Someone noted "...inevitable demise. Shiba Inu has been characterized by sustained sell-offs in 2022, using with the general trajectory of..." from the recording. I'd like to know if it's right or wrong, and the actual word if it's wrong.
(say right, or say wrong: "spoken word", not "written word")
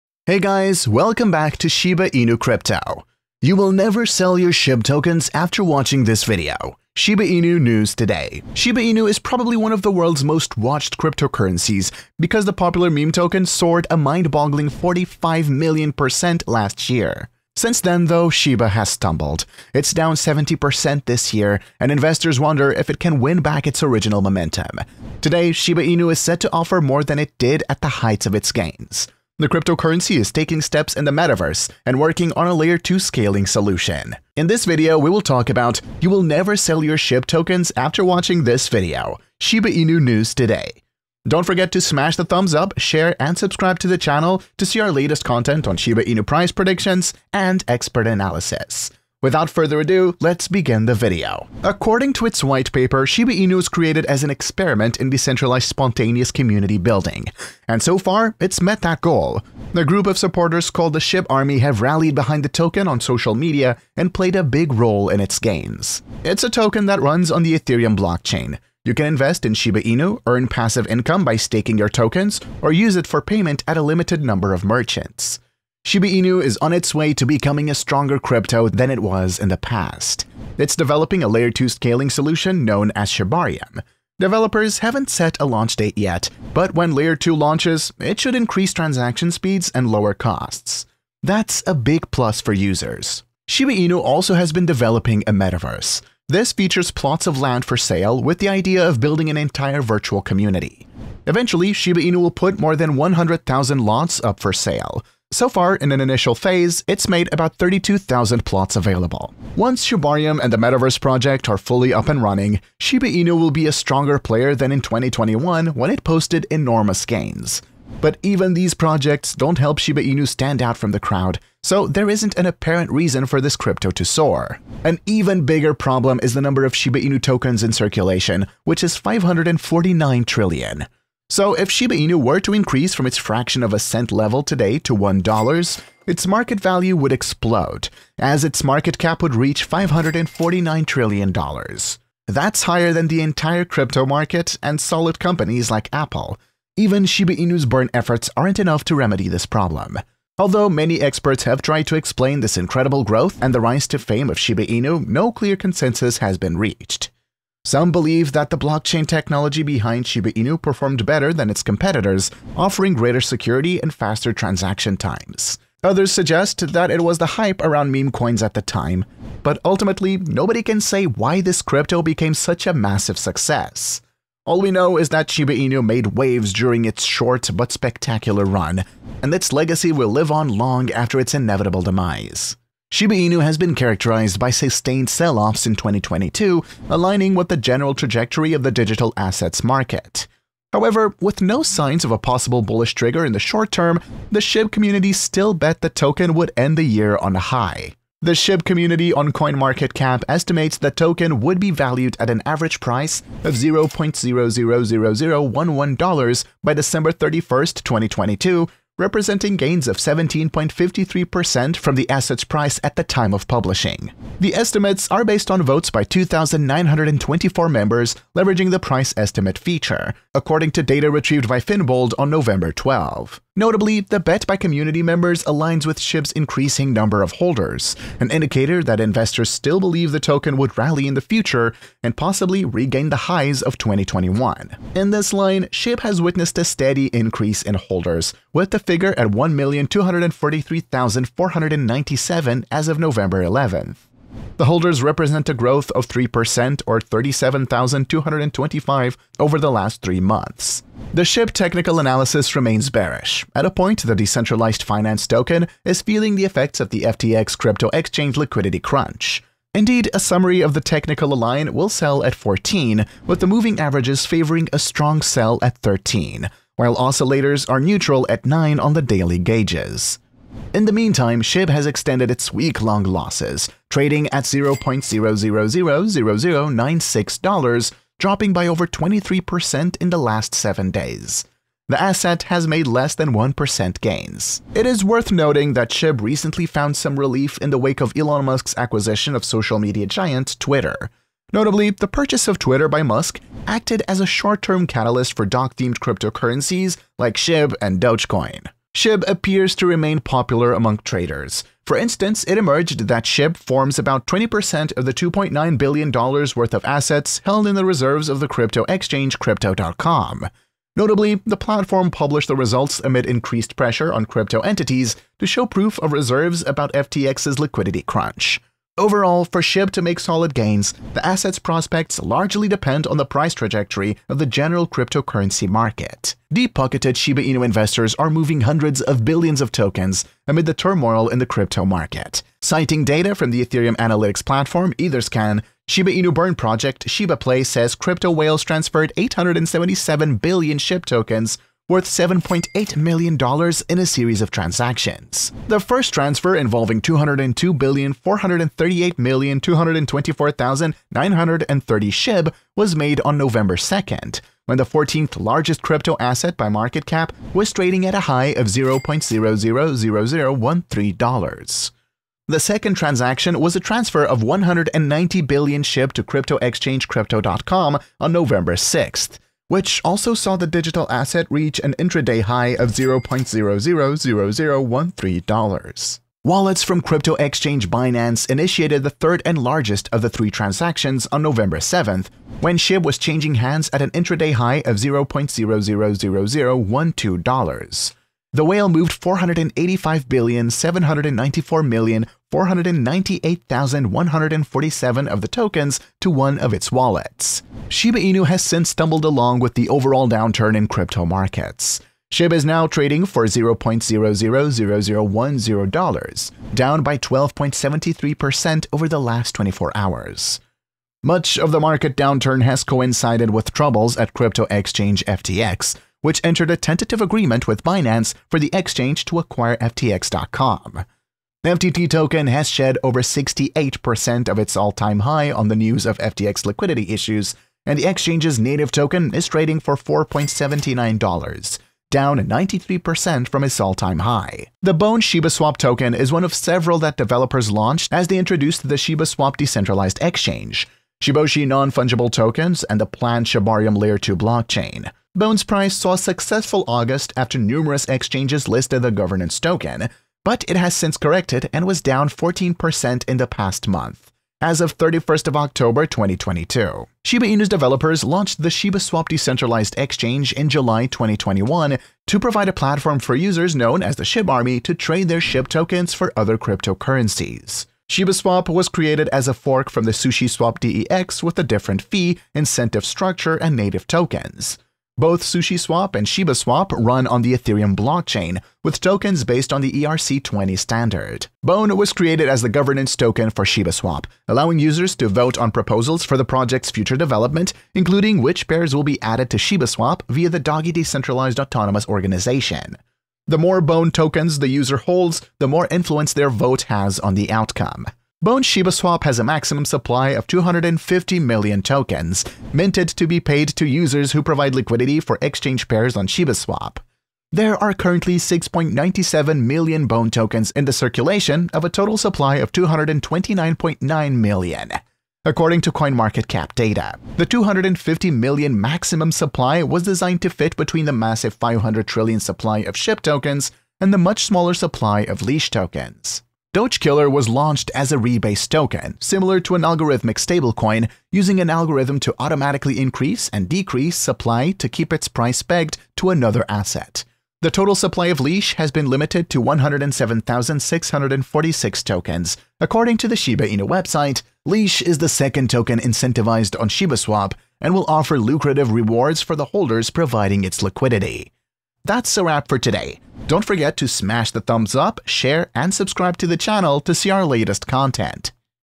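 wrong: "aligning", not "using".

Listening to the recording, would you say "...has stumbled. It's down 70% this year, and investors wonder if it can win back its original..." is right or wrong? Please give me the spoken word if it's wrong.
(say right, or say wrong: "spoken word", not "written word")
right.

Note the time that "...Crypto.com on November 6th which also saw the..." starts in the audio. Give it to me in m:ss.
6:07.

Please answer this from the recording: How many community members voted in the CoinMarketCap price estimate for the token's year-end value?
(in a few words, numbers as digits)
2,924.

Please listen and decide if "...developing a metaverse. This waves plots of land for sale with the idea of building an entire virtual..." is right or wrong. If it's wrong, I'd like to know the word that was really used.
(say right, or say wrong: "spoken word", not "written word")
wrong: "features", not "waves".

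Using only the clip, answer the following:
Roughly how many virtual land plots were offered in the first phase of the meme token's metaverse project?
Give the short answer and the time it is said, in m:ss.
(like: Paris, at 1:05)
32,000, at 1:47.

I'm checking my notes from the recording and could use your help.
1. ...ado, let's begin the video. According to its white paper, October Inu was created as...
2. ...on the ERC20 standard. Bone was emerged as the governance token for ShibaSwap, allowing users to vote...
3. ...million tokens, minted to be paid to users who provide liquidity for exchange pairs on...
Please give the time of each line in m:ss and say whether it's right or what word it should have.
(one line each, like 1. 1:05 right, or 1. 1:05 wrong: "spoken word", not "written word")
1. 0:49 wrong: "Shiba", not "October"
2. 7:59 wrong: "created", not "emerged"
3. 8:21 right.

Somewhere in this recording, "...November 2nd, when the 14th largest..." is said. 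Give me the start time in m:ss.
5:53.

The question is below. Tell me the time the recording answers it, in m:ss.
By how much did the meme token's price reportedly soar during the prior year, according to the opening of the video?
0:14.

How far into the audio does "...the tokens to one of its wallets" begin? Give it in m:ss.
6:35.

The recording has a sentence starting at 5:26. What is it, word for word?
Deep-pocketed Shiba Inu investors are moving hundreds of billions of tokens amid the turmoil in the crypto market.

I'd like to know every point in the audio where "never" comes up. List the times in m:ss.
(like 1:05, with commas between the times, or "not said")
0:03, 0:36.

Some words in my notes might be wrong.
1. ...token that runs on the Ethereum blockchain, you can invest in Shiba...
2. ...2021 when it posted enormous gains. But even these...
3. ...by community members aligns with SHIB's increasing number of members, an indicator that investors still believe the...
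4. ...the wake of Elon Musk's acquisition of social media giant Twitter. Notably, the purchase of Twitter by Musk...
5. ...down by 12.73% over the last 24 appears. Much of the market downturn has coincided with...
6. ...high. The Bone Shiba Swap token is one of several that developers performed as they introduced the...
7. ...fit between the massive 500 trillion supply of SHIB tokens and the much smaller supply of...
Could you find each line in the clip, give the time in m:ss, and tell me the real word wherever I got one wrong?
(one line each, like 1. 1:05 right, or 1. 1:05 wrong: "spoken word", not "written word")
1. 1:06 right
2. 1:54 right
3. 3:44 wrong: "holders", not "members"
4. 4:47 right
5. 6:46 wrong: "hours", not "appears"
6. 7:14 wrong: "launched", not "performed"
7. 8:40 right.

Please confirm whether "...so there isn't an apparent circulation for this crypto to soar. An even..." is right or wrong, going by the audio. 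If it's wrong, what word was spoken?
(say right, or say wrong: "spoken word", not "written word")
wrong: "reason", not "circulation".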